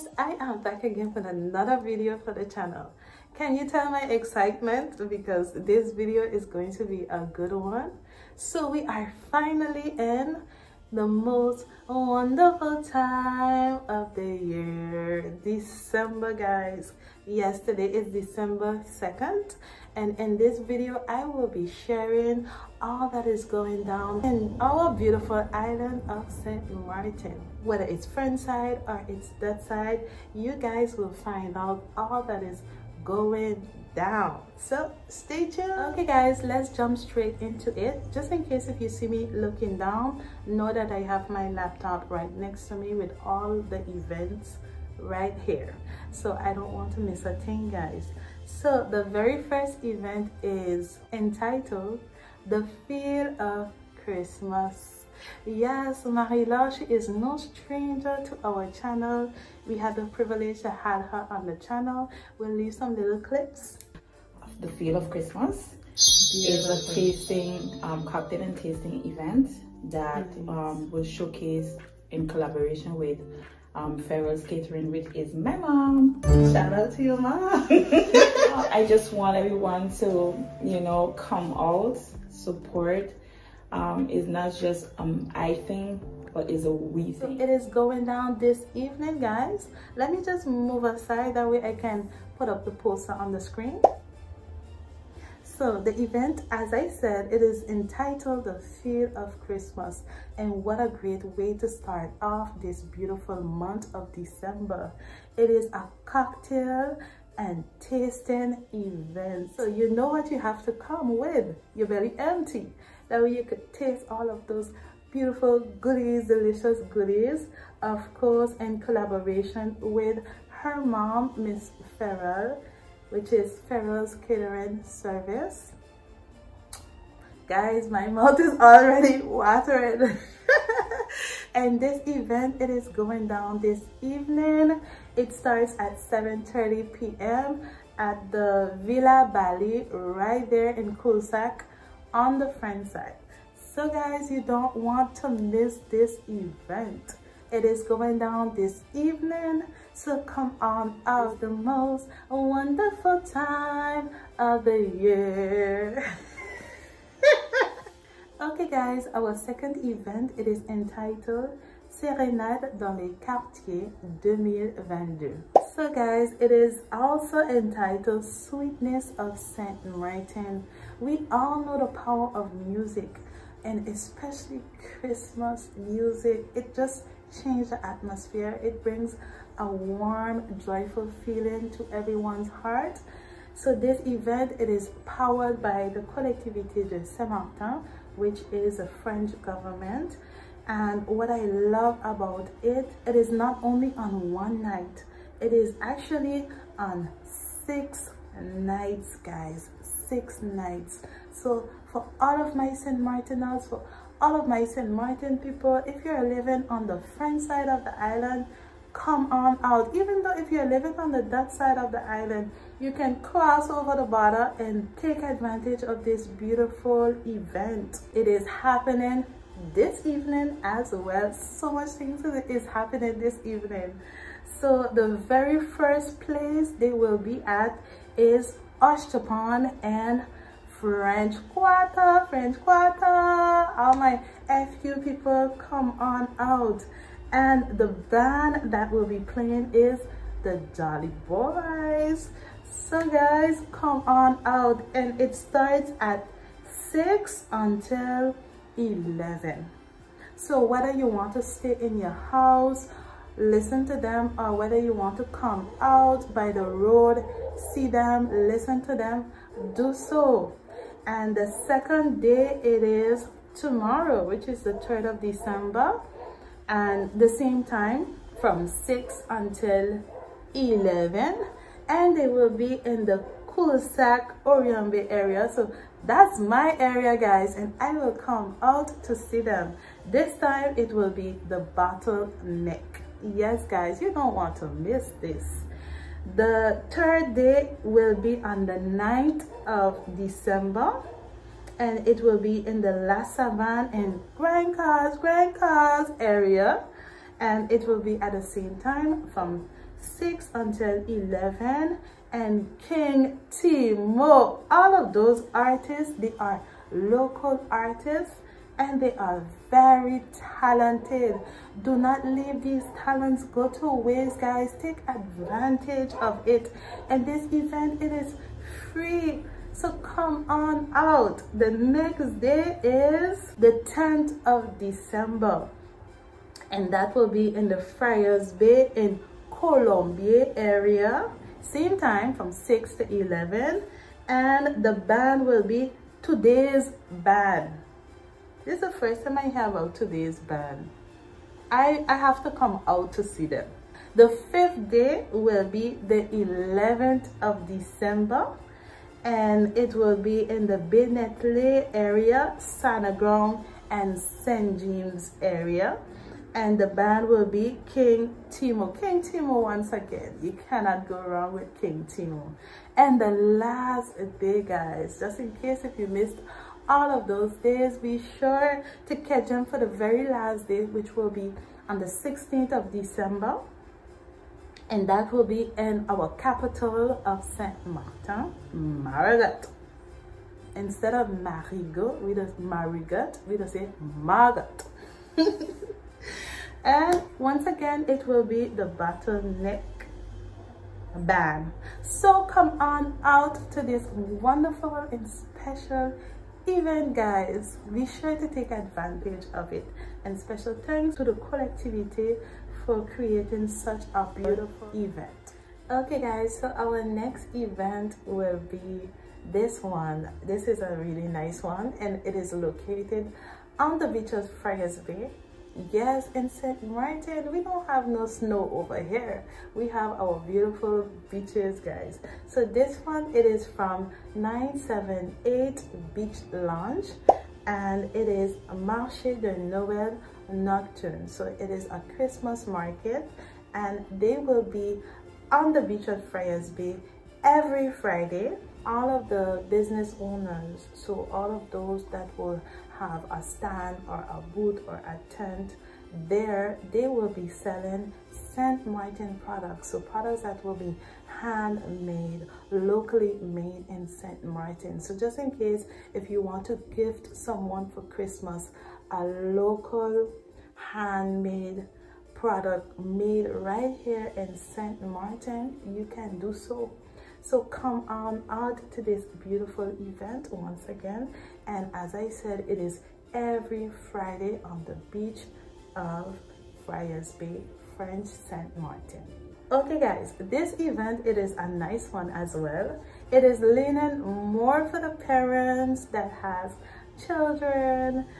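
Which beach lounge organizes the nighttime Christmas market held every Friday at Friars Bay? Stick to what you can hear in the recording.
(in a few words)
978 Beach Lounge.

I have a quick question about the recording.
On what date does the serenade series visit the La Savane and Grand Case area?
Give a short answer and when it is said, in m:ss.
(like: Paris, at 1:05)
9th of December, at 4:48.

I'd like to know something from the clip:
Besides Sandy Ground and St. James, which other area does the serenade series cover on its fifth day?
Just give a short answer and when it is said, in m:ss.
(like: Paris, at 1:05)
Benetley, at 5:50.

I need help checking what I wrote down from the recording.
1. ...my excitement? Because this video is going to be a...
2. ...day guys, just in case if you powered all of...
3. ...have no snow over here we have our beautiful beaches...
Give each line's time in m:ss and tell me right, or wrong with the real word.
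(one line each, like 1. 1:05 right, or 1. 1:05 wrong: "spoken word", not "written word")
1. 0:03 right
2. 6:04 wrong: "missed", not "powered"
3. 6:57 right.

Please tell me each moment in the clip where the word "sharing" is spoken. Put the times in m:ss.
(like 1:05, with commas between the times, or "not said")
0:21.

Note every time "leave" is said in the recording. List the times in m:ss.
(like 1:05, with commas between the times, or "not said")
1:02, 5:12.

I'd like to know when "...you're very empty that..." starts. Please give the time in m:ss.
1:51.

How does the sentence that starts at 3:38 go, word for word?
It is happening this evening as well.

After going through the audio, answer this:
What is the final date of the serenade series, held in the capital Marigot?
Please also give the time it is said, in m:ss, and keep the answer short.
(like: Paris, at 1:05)
16th of December, at 6:12.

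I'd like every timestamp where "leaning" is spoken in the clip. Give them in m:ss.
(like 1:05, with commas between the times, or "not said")
8:03.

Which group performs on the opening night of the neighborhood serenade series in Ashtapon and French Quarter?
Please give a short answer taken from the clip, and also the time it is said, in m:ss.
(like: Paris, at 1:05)
Jolly Boys, at 4:00.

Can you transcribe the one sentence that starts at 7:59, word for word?
Okay guys, this event, it is a nice one as well.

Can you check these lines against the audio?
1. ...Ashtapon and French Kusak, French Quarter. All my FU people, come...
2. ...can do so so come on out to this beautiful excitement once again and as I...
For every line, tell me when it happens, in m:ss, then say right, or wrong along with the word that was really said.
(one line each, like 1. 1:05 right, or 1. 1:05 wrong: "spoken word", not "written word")
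1. 3:48 wrong: "Quarter", not "Kusak"
2. 7:46 wrong: "event", not "excitement".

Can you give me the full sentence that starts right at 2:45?
So guys, it is also entitled Sweetness of Saint Martin.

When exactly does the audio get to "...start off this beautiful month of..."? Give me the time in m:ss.
1:41.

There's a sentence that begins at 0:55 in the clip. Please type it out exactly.
Yes, marie she is no stranger to our channel.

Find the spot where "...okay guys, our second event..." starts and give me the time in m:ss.
2:38.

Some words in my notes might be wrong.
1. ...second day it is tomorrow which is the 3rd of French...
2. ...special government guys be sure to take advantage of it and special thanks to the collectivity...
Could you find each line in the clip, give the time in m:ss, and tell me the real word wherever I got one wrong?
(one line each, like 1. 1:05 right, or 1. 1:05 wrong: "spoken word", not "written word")
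1. 4:21 wrong: "December", not "French"
2. 6:35 wrong: "event", not "government".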